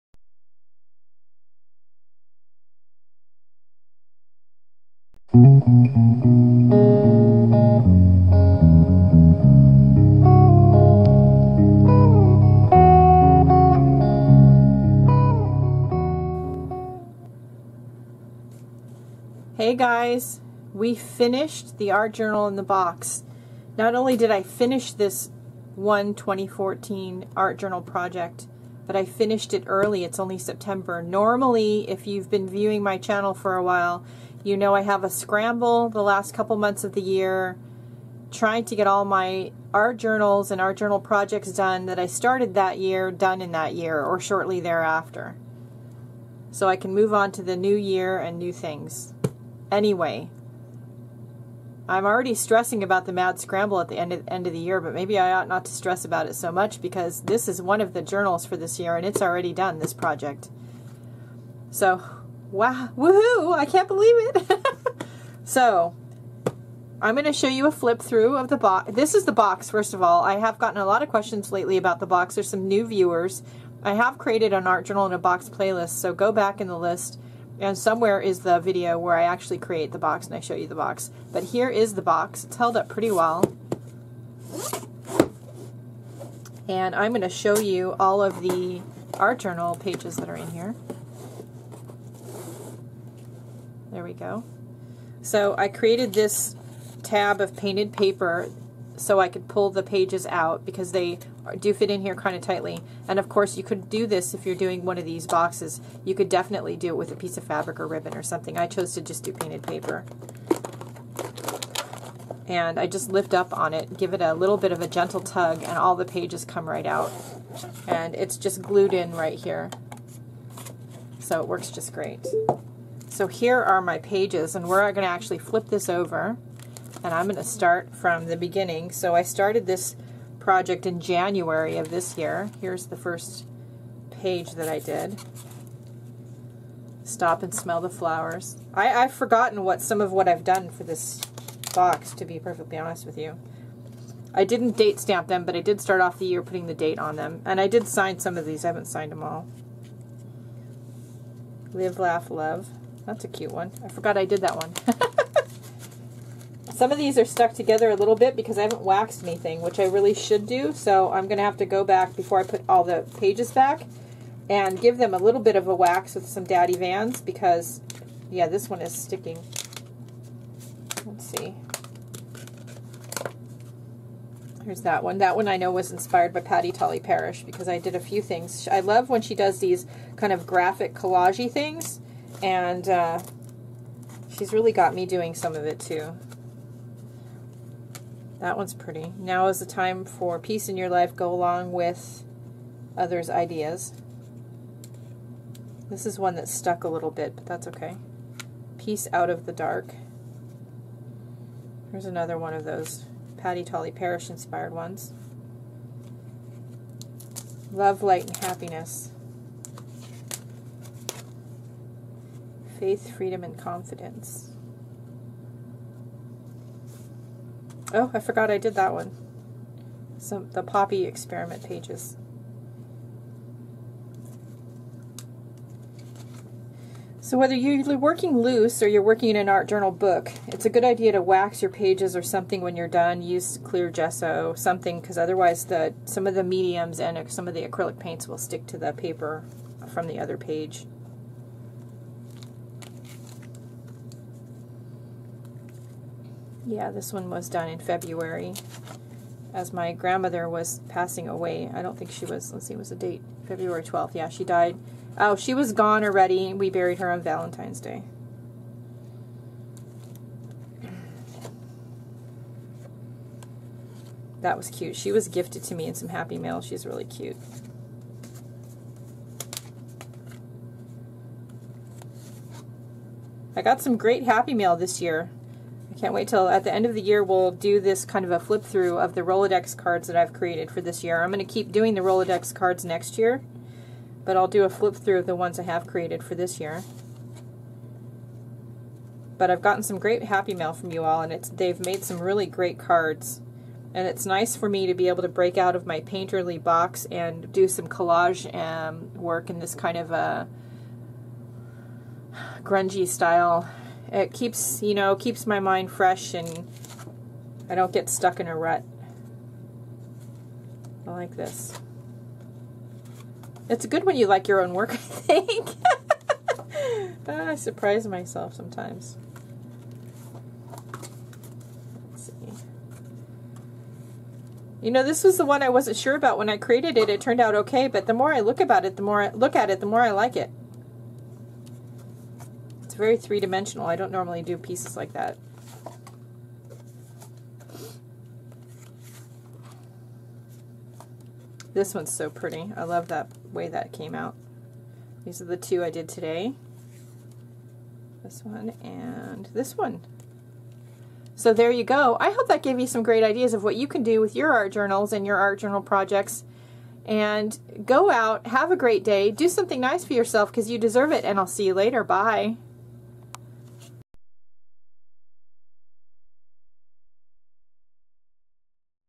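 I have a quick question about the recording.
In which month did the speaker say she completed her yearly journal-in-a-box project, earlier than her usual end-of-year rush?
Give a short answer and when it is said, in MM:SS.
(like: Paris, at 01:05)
September, at 00:30.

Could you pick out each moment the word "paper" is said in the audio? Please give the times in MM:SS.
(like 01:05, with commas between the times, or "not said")
01:37, 01:49, 03:58.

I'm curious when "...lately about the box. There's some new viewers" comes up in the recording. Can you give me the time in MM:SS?
01:11.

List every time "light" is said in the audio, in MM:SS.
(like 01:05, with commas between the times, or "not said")
03:28.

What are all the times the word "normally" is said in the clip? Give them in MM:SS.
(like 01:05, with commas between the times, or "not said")
00:31, 05:34.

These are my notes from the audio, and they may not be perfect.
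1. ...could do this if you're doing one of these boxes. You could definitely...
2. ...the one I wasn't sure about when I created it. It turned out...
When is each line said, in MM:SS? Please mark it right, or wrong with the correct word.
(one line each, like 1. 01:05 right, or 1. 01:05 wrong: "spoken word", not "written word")
1. 01:43 right
2. 05:25 right.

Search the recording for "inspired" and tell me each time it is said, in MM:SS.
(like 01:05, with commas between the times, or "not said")
02:55, 03:24.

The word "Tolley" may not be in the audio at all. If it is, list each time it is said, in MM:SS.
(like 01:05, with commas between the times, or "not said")
02:56, 03:23.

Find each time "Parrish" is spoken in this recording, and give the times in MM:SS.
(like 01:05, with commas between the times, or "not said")
02:56, 03:23.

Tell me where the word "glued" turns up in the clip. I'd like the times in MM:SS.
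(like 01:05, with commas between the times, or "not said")
01:58.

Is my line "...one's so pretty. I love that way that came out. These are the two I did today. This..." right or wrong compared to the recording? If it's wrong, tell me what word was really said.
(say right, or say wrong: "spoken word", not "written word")
right.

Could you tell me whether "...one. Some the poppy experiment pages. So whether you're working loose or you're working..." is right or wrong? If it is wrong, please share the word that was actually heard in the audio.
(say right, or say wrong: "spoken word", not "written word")
right.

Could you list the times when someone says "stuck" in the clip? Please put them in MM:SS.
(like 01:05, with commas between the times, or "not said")
02:37, 03:16, 05:08.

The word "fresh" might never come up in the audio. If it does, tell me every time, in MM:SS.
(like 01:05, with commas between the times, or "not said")
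05:05.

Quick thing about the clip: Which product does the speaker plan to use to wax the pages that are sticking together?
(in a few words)
Daddy Vans.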